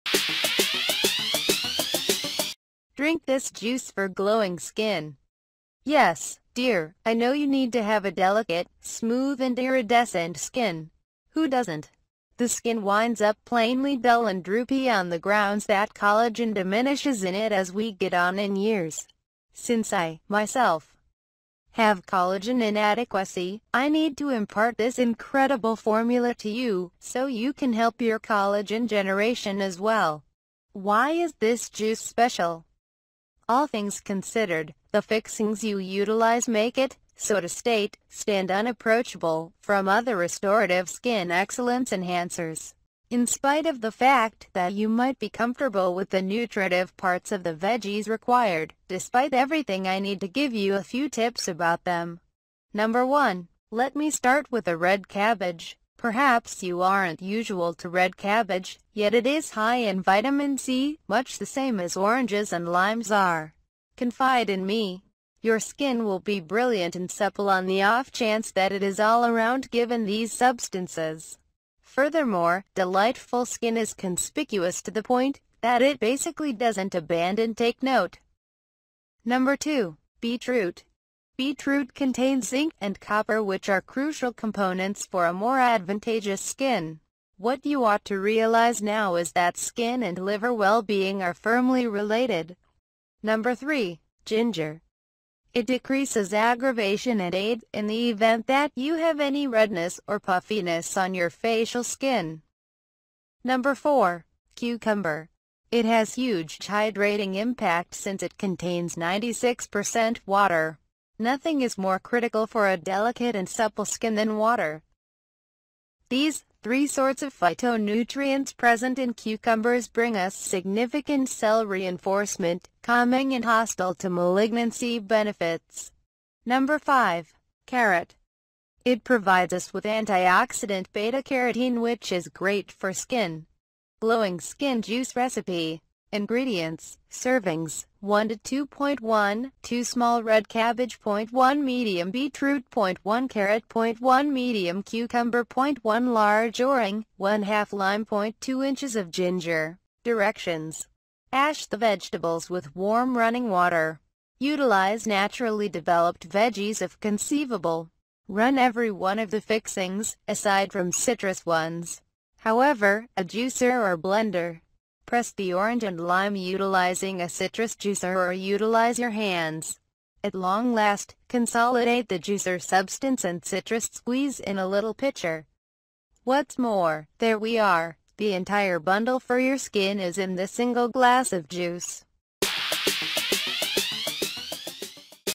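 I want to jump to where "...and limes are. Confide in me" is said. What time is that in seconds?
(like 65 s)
62 s.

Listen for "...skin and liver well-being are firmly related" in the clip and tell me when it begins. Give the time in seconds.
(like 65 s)
89 s.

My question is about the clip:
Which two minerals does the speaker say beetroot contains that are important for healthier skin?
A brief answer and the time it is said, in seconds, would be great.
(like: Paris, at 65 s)
zinc and copper, at 82 s.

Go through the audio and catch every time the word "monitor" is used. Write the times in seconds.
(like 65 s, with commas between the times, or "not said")
not said.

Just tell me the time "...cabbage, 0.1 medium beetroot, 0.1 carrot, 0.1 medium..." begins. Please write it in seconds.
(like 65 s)
140 s.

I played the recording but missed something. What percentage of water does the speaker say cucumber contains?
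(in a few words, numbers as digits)
96%.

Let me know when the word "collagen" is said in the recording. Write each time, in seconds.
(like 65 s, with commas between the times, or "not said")
15 s, 22 s, 28 s.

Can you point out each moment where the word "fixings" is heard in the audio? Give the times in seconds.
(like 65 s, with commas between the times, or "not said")
35 s, 159 s.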